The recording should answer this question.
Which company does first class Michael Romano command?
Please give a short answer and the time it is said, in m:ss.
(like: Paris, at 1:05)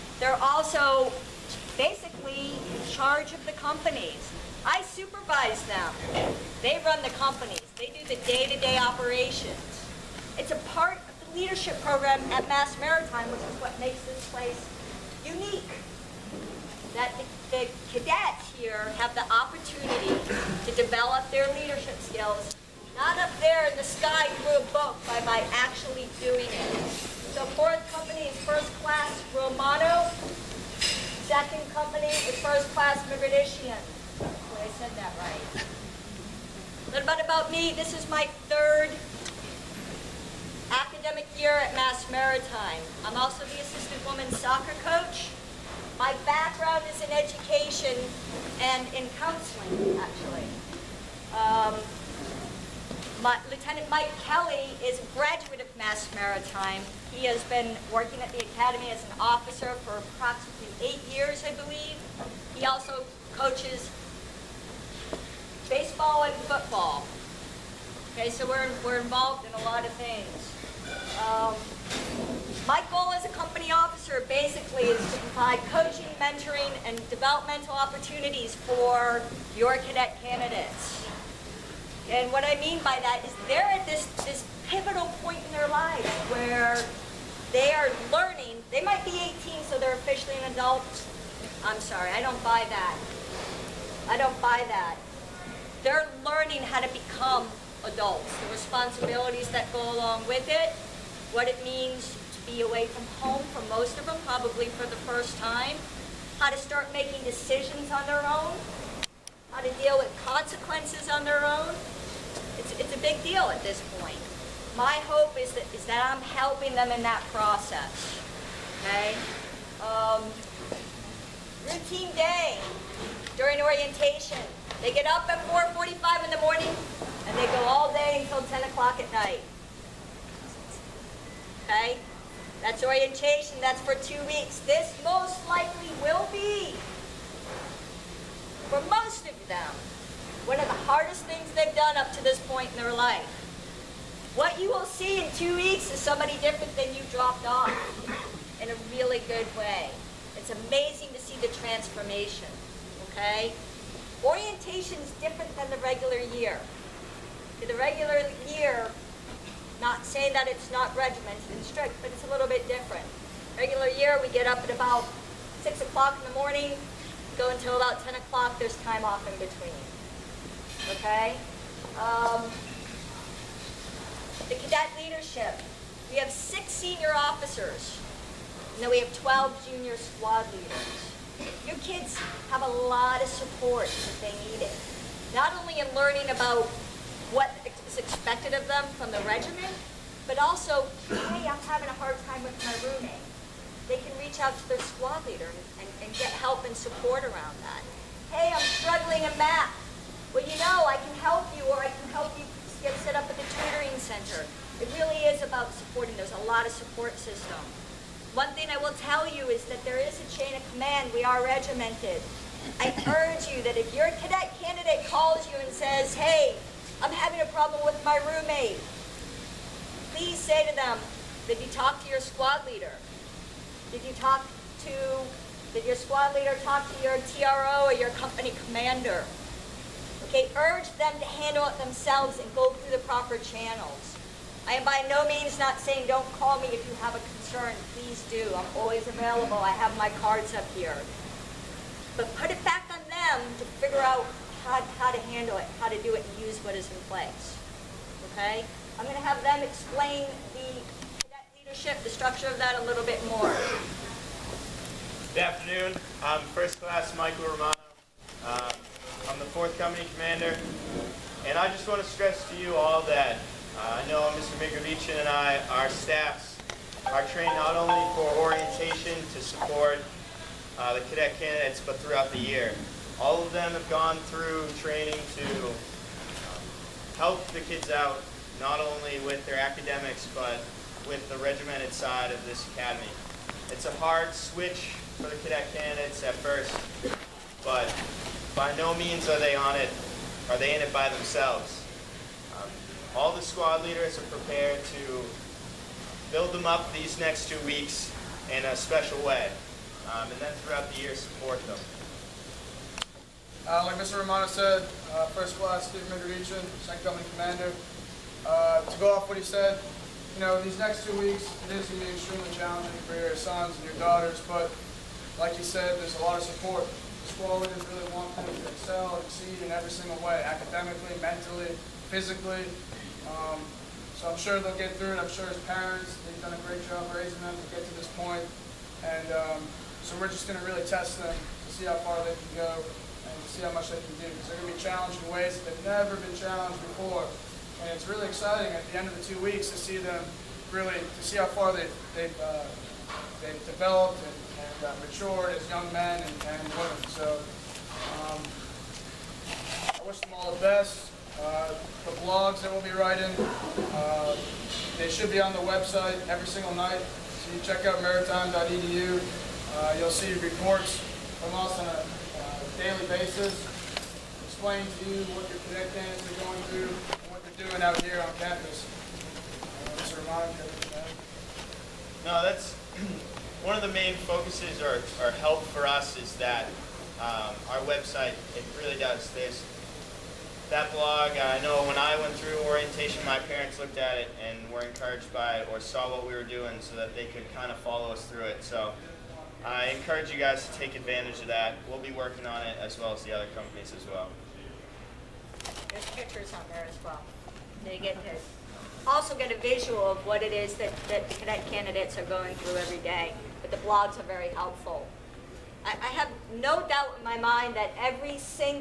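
4th Company, at 4:19.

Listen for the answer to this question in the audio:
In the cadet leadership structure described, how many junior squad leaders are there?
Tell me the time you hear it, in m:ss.
2:59.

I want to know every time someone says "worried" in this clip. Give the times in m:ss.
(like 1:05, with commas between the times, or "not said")
not said.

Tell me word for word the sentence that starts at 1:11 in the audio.
Um, my goal as a company officer basically is to provide coaching, mentoring, and developmental opportunities for your cadet candidates.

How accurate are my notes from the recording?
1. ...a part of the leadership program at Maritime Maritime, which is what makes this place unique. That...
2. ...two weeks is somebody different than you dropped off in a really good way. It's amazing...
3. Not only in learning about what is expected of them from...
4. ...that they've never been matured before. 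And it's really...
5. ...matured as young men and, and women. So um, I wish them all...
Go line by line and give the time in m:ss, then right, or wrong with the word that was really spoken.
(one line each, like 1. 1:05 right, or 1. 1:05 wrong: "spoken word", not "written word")
1. 0:10 wrong: "Mass", not "Maritime"
2. 2:25 right
3. 3:05 right
4. 5:35 wrong: "challenged", not "matured"
5. 5:45 right.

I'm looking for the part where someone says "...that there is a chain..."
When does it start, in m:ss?
3:29.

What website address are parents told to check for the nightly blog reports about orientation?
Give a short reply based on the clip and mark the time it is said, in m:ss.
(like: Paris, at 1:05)
maritime.edu, at 5:58.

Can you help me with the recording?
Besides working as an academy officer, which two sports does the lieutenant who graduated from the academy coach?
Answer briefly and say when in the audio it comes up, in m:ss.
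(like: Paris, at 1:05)
Baseball and football, at 1:05.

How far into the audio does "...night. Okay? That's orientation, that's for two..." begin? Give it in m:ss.
2:09.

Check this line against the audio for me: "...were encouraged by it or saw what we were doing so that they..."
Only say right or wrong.
right.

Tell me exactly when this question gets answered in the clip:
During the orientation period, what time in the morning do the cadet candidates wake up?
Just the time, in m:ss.
2:05.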